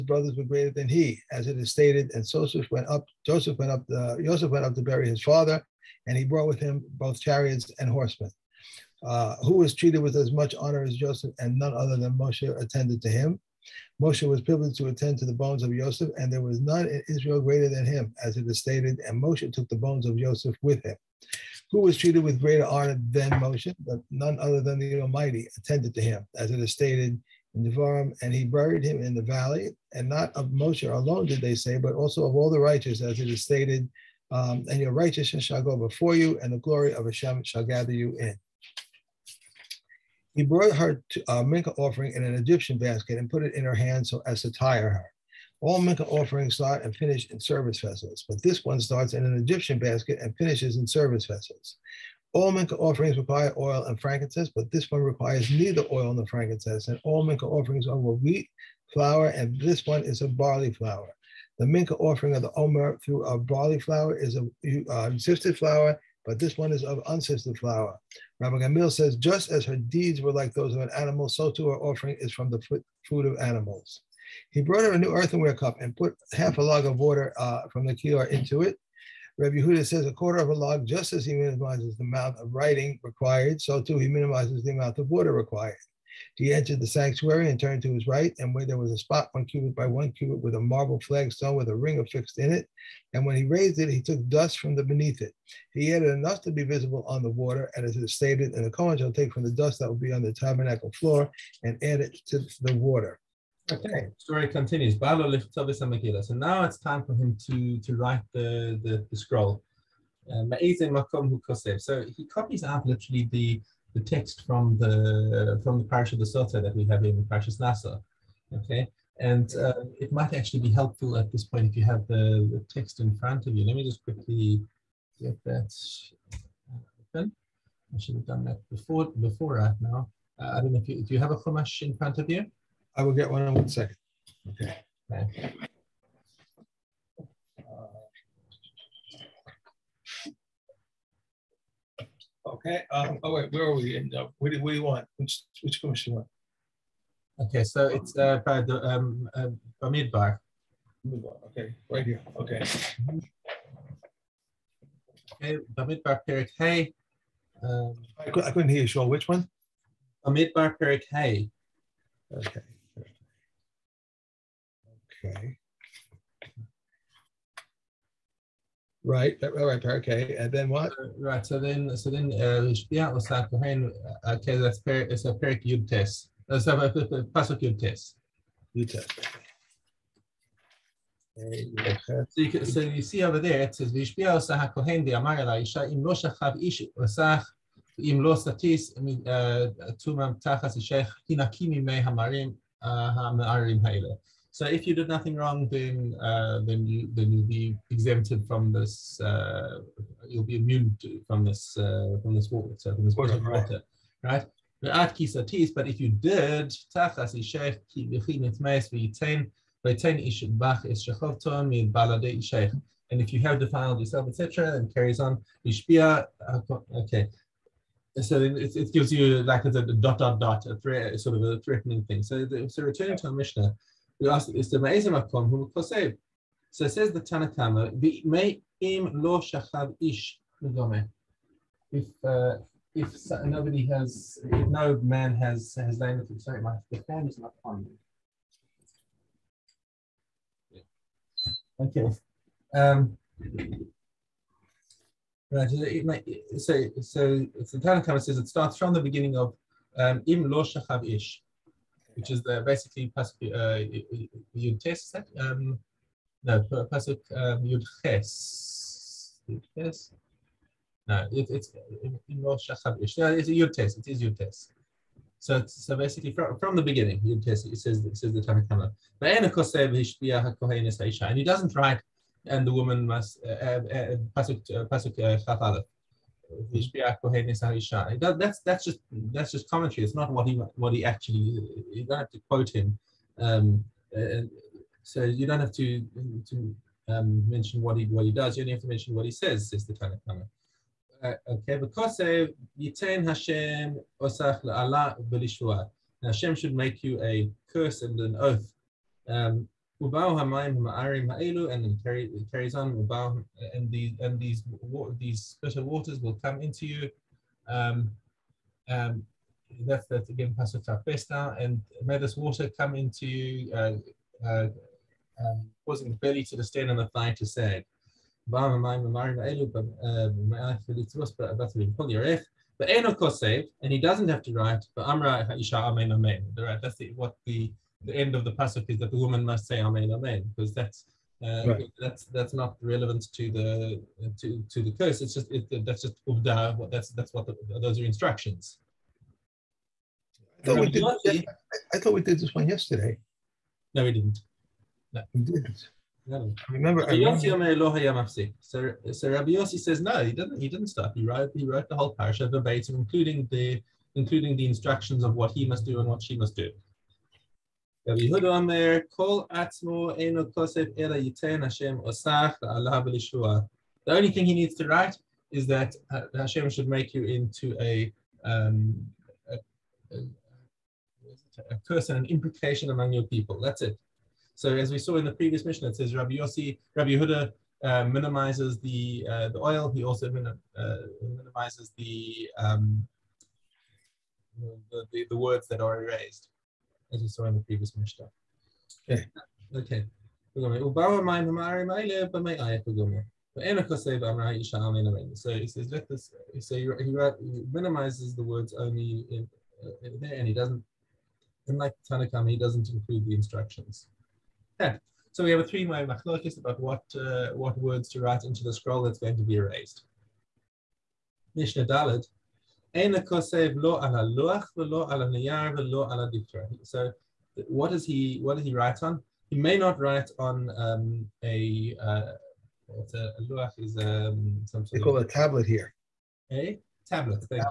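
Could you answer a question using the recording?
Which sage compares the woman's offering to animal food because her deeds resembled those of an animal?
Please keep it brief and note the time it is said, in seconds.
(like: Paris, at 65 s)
Rabbi Gamliel, at 68 s.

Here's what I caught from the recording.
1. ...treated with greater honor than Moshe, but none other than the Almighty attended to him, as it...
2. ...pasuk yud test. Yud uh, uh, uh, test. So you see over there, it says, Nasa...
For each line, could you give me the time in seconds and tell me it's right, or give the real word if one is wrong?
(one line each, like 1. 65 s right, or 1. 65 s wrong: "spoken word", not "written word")
1. 21 s right
2. 177 s wrong: "Vishbia", not "Nasa".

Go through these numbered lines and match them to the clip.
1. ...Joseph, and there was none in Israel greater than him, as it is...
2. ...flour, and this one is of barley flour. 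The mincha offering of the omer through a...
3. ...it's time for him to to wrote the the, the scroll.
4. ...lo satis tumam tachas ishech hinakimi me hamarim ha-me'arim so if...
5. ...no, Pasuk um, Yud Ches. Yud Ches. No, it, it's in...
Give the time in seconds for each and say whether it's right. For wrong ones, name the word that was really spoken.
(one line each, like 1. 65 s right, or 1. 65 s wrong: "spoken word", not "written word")
1. 15 s right
2. 58 s right
3. 106 s wrong: "write", not "wrote"
4. 188 s right
5. 256 s right.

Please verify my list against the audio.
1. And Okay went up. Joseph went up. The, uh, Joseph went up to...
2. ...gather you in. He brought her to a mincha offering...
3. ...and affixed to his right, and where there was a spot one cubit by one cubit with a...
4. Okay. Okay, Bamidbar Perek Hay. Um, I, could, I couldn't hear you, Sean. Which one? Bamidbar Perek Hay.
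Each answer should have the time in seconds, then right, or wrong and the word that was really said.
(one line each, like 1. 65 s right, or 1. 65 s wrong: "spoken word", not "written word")
1. 2 s wrong: "Joseph", not "Okay"
2. 37 s right
3. 87 s wrong: "turned", not "affixed"
4. 152 s right.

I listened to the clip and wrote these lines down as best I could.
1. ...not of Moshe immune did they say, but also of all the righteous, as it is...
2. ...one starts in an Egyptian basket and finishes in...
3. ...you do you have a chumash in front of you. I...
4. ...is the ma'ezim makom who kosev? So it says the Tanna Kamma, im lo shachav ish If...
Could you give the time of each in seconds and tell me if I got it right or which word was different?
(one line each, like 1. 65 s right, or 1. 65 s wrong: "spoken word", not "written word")
1. 30 s wrong: "alone", not "immune"
2. 48 s right
3. 130 s right
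4. 224 s right.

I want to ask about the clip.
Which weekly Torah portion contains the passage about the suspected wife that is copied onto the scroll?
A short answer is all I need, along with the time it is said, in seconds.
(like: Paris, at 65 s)
Nasa, at 117 s.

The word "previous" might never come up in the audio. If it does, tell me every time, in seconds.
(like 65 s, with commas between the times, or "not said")
375 s, 387 s.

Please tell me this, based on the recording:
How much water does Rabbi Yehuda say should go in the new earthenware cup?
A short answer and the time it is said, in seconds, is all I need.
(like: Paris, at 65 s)
a quarter of a log, at 80 s.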